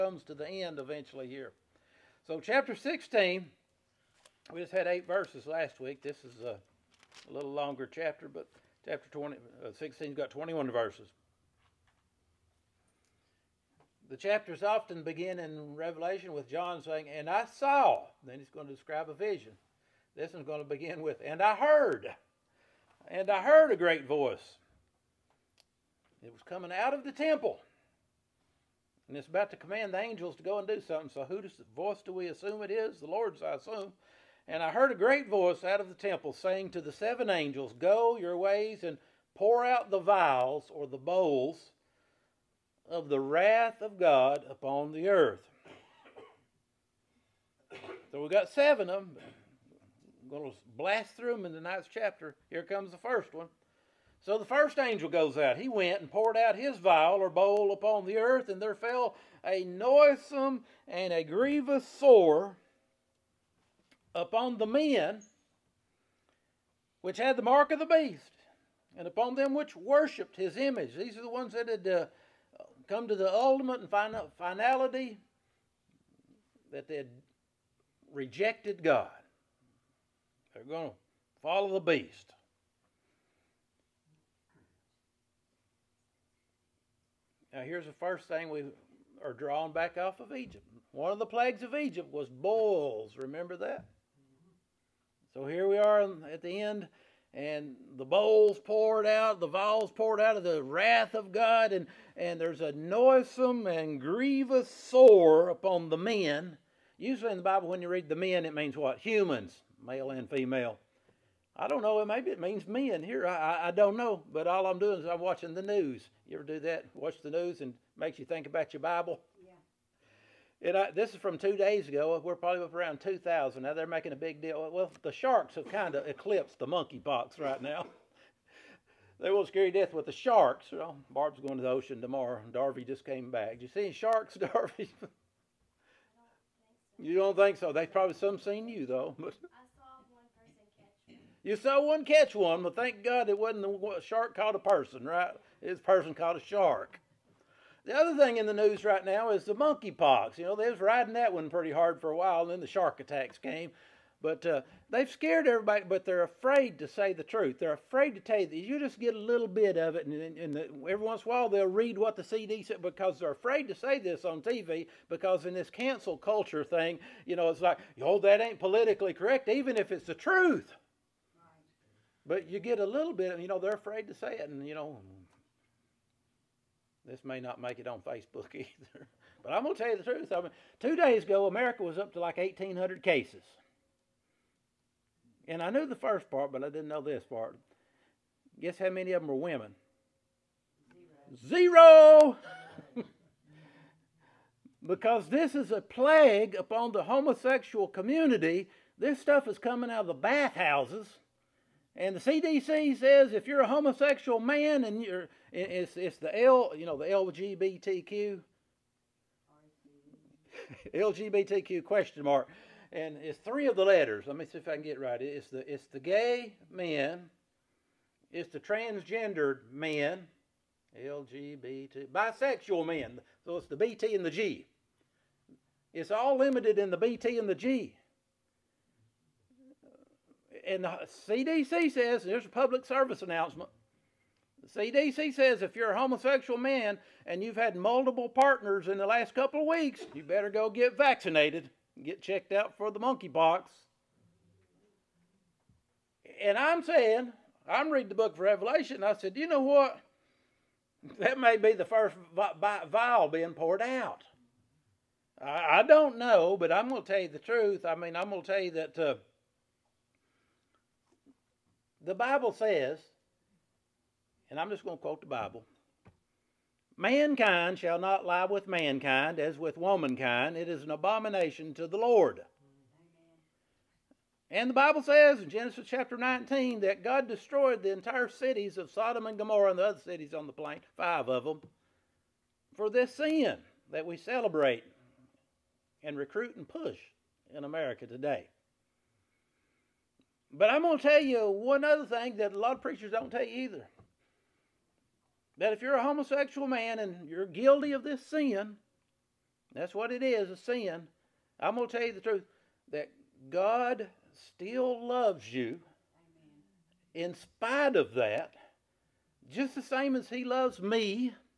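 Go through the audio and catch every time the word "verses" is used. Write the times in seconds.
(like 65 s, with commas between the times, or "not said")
5 s, 10 s.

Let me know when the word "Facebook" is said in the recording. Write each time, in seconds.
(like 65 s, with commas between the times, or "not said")
177 s.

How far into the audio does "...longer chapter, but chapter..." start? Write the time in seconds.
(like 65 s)
7 s.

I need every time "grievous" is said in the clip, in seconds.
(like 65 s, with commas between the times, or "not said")
61 s, 103 s.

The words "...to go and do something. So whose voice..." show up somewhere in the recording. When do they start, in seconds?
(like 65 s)
30 s.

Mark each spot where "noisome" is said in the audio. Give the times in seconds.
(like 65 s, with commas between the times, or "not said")
59 s, 102 s.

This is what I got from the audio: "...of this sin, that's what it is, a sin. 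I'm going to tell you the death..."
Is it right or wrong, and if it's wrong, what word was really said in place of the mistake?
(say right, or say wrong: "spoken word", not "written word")
wrong: "truth", not "death".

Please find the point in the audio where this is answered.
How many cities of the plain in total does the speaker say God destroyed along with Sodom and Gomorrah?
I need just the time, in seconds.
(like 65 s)
280 s.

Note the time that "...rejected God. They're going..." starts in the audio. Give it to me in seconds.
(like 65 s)
78 s.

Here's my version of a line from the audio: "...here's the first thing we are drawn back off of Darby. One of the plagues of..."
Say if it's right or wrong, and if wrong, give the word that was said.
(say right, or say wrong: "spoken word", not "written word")
wrong: "Egypt", not "Darby".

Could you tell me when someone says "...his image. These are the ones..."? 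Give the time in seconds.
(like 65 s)
70 s.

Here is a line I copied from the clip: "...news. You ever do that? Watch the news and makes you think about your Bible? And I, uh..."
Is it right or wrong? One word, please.
right.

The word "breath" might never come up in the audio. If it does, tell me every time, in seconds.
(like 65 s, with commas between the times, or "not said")
not said.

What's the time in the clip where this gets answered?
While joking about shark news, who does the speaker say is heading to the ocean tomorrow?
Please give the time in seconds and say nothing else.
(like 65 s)
131 s.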